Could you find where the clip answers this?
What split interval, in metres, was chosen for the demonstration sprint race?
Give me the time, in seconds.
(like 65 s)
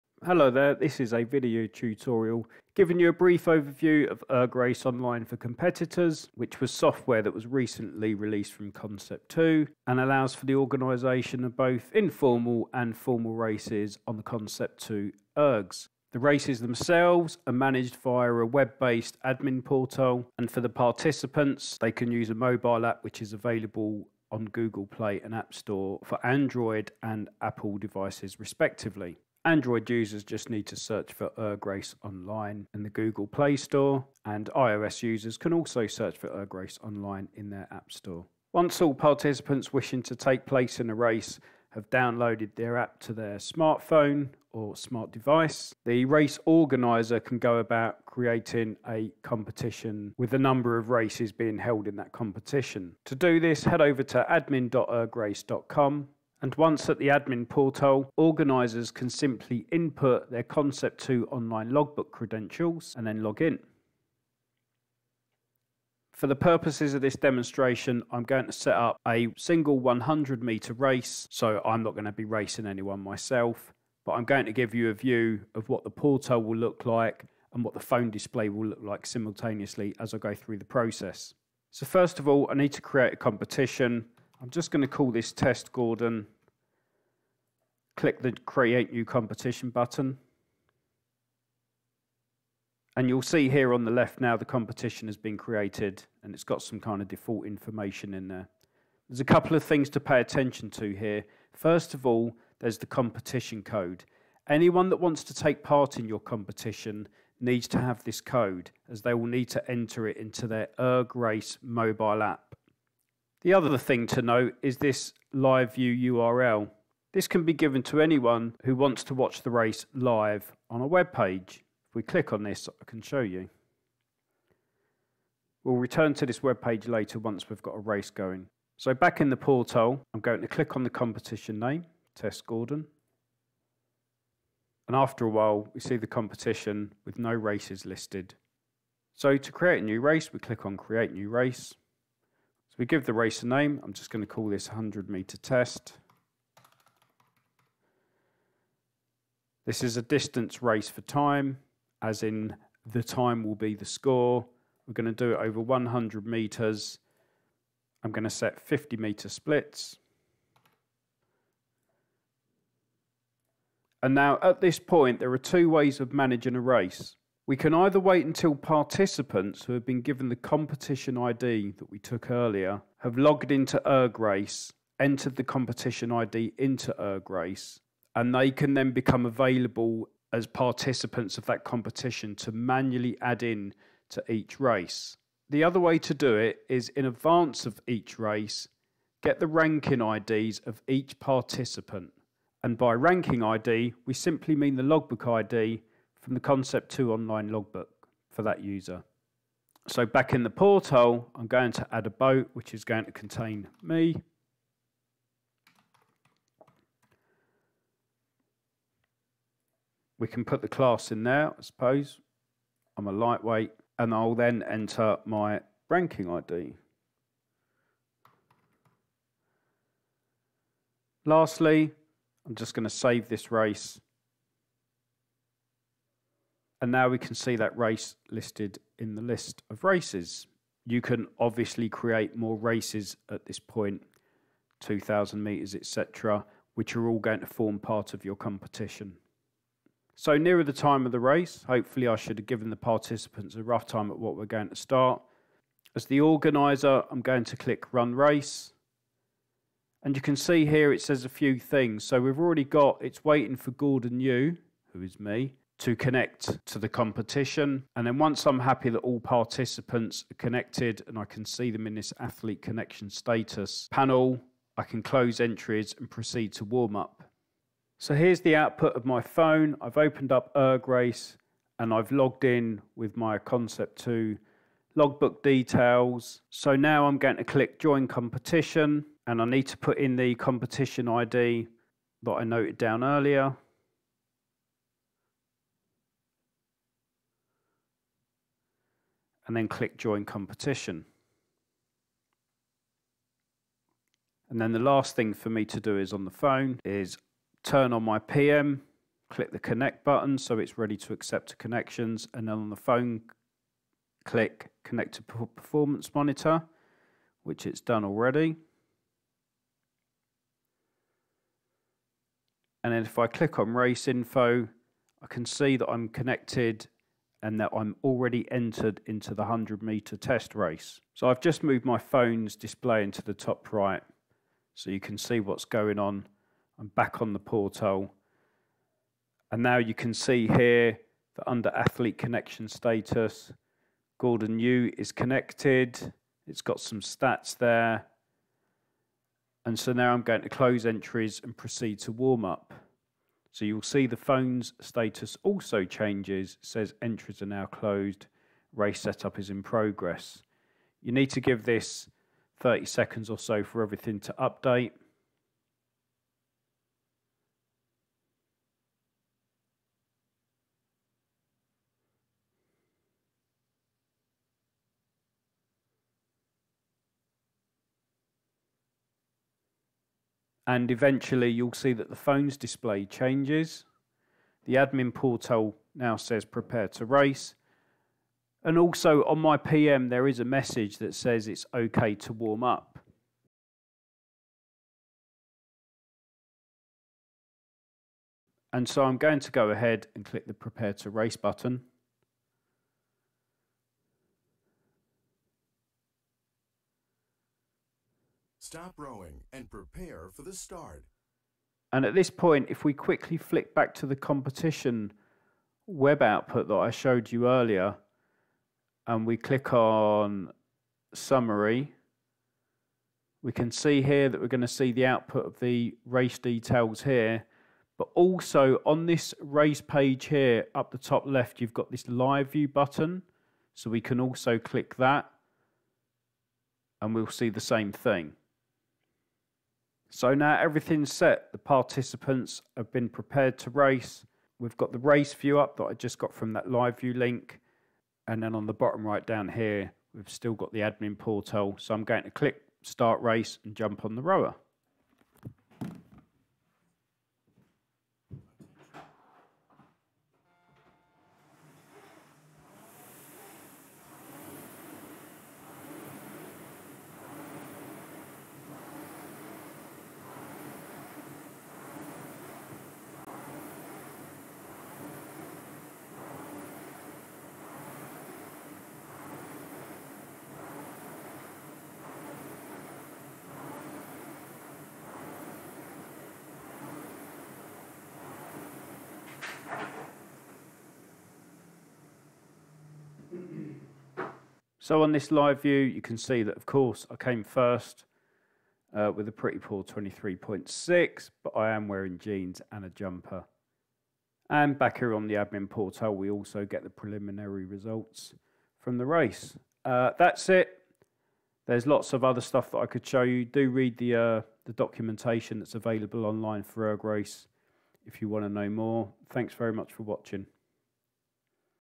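158 s.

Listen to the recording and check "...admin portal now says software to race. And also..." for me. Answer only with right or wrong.
wrong.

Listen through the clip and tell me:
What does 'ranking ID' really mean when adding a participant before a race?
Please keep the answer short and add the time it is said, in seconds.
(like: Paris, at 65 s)
logbook ID, at 194 s.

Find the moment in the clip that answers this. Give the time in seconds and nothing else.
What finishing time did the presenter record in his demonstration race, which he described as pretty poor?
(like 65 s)
489 s.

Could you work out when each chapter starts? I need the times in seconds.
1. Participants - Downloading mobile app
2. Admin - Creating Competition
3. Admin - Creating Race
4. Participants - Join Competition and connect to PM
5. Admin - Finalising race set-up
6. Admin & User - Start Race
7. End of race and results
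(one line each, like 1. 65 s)
1. 28 s
2. 38 s
3. 138 s
4. 271 s
5. 308 s
6. 388 s
7. 406 s.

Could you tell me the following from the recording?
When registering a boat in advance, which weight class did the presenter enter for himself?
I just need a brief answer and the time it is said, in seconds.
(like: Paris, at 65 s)
lightweight, at 213 s.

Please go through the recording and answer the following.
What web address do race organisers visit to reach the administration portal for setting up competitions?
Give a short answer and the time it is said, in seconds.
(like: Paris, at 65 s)
admin.ergrace.com, at 54 s.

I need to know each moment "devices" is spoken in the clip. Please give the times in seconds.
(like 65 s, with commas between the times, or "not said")
27 s, 45 s.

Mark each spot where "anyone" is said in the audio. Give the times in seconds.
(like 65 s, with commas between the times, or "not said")
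72 s, 104 s, 117 s.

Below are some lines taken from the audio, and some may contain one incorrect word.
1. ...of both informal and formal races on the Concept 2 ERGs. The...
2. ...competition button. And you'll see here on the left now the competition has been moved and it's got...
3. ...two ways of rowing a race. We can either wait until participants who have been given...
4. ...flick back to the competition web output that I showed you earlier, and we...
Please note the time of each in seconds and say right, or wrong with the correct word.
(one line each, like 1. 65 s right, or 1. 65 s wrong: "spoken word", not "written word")
1. 11 s right
2. 89 s wrong: "created", not "moved"
3. 165 s wrong: "managing", not "rowing"
4. 403 s right.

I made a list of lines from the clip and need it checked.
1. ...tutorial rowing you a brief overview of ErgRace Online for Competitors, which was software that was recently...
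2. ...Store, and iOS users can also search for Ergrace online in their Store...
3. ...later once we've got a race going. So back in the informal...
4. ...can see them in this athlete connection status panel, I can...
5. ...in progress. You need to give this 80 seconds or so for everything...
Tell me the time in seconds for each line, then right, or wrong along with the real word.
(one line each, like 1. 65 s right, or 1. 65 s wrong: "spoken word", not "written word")
1. 1 s wrong: "giving", not "rowing"
2. 33 s wrong: "App", not "Store"
3. 126 s wrong: "portal", not "informal"
4. 261 s right
5. 349 s wrong: "30", not "80".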